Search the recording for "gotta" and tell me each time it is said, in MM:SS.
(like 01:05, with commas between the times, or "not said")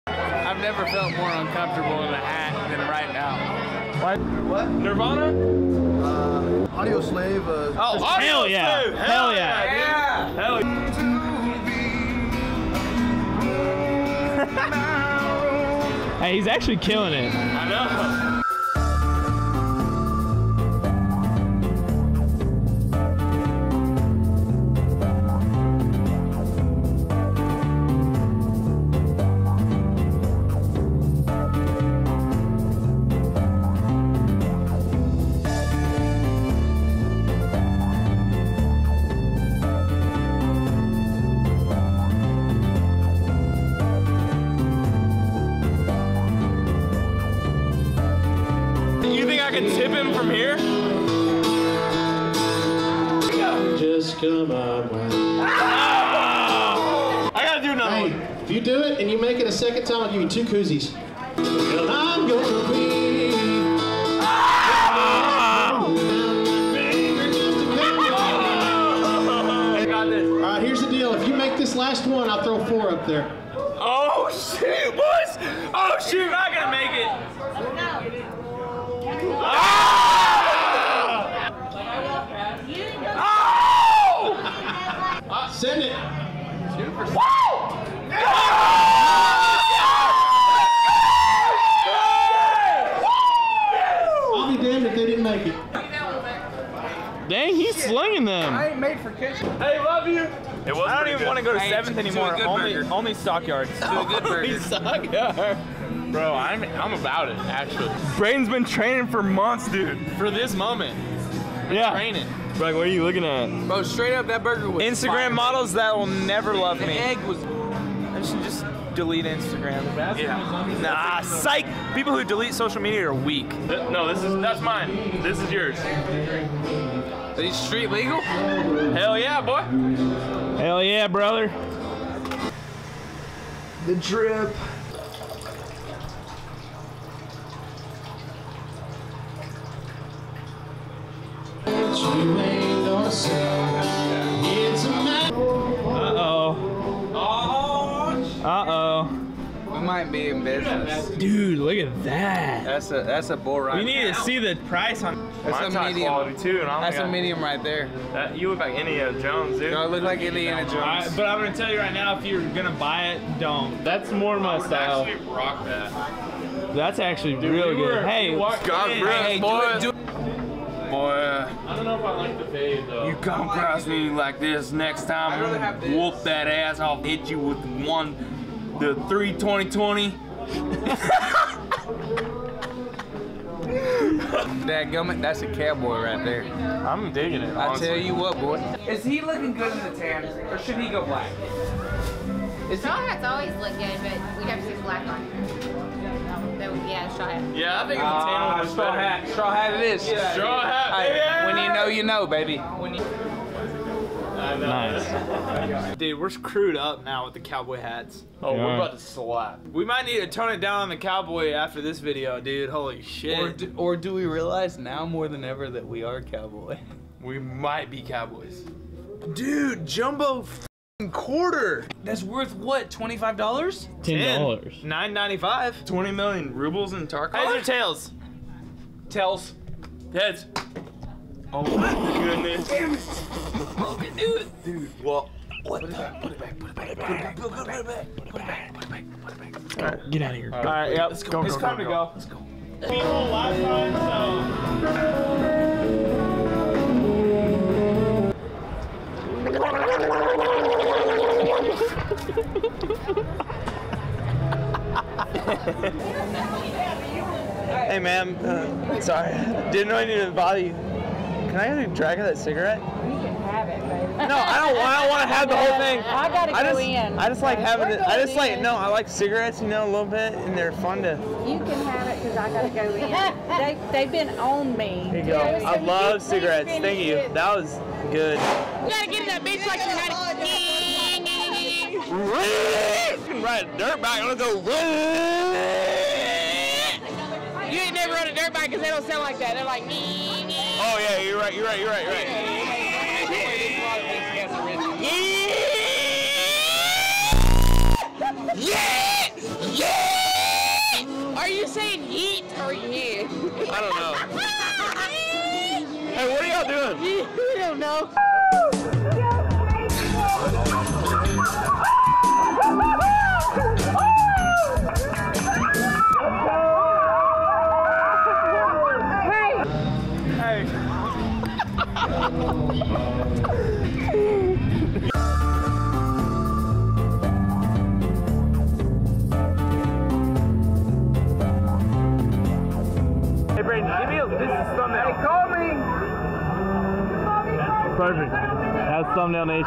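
00:57, 01:16, 04:26, 04:32, 04:38.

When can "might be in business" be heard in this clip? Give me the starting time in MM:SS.
02:29.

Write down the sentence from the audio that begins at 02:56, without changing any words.
I'll hit you with one, the three twenty twenty.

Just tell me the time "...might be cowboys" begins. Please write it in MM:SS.
03:37.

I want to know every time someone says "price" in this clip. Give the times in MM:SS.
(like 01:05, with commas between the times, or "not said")
02:34.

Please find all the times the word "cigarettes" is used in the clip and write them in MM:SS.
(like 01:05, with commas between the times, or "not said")
04:22, 04:29, 04:36.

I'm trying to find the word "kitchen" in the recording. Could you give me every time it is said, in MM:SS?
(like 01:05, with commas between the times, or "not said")
01:39.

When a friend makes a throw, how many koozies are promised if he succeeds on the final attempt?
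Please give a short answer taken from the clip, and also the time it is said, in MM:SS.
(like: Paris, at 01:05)
4, at 01:12.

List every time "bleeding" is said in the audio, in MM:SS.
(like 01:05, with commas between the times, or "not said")
not said.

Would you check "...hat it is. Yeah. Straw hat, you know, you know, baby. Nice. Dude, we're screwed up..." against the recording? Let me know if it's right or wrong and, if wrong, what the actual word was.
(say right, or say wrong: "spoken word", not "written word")
right.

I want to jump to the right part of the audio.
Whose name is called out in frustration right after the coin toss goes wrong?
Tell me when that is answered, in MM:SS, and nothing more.
03:53.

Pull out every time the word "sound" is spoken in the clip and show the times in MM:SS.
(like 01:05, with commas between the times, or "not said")
04:49.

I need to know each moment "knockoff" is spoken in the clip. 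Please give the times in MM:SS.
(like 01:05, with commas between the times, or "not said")
not said.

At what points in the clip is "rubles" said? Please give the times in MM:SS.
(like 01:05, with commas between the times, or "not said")
03:46.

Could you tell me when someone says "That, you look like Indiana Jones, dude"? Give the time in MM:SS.
02:38.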